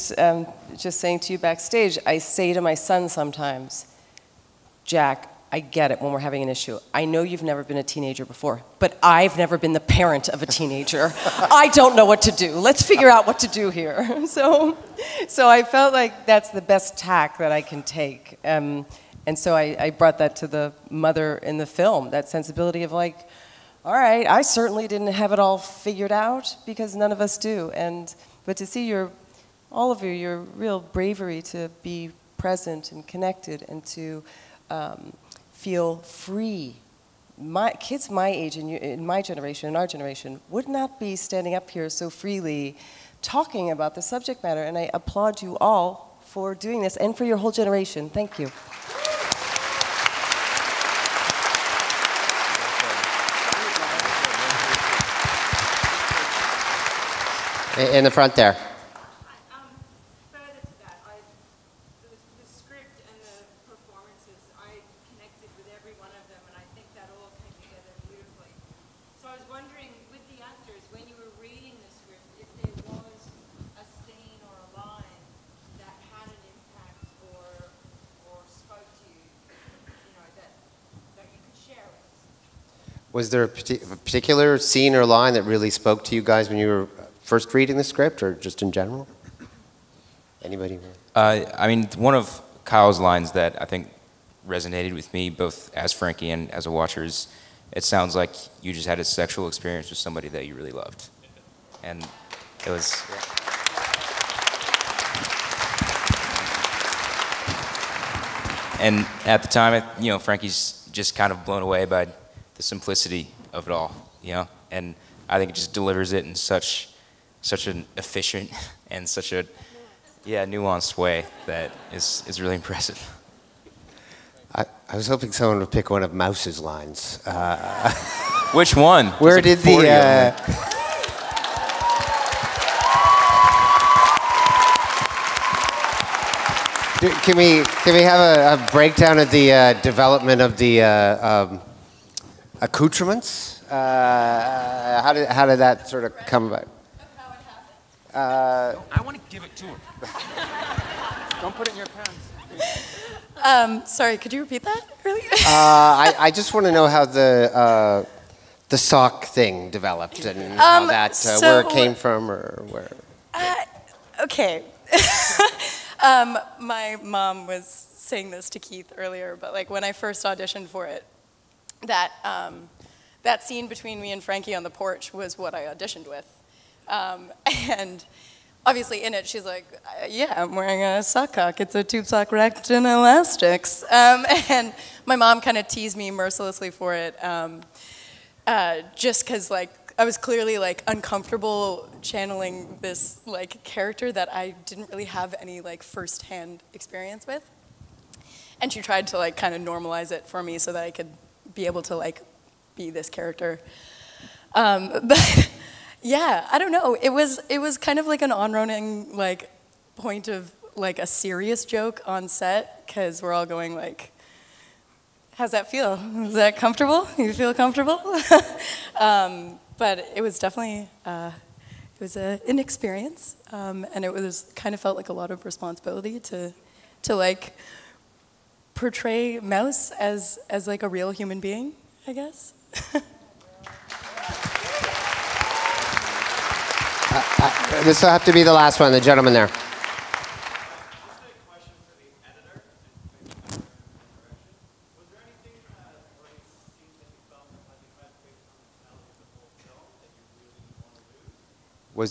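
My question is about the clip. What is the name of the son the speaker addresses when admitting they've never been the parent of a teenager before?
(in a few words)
Jack.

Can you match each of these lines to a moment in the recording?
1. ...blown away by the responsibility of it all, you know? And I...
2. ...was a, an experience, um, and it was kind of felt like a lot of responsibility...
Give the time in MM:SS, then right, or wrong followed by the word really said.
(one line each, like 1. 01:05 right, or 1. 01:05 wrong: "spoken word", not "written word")
1. 01:51 wrong: "simplicity", not "responsibility"
2. 03:42 right.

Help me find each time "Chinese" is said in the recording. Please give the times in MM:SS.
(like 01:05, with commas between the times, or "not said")
not said.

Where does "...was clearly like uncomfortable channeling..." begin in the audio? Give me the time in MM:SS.
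03:10.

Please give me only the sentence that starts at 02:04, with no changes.
I, I was hoping someone would pick one of Mouse's lines.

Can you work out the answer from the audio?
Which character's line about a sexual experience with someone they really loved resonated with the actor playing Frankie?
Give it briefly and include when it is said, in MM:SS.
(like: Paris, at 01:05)
Kyle, at 01:32.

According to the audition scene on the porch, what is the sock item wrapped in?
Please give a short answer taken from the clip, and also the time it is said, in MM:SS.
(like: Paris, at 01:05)
elastics, at 03:02.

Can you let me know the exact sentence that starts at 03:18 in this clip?
And she tried to like kind of normalize it for me so that I could be able to like be this character.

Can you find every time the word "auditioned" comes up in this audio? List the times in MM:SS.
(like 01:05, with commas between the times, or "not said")
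02:50, 02:55.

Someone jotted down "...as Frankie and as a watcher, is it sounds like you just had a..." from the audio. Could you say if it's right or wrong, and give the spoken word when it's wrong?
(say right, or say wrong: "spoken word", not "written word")
right.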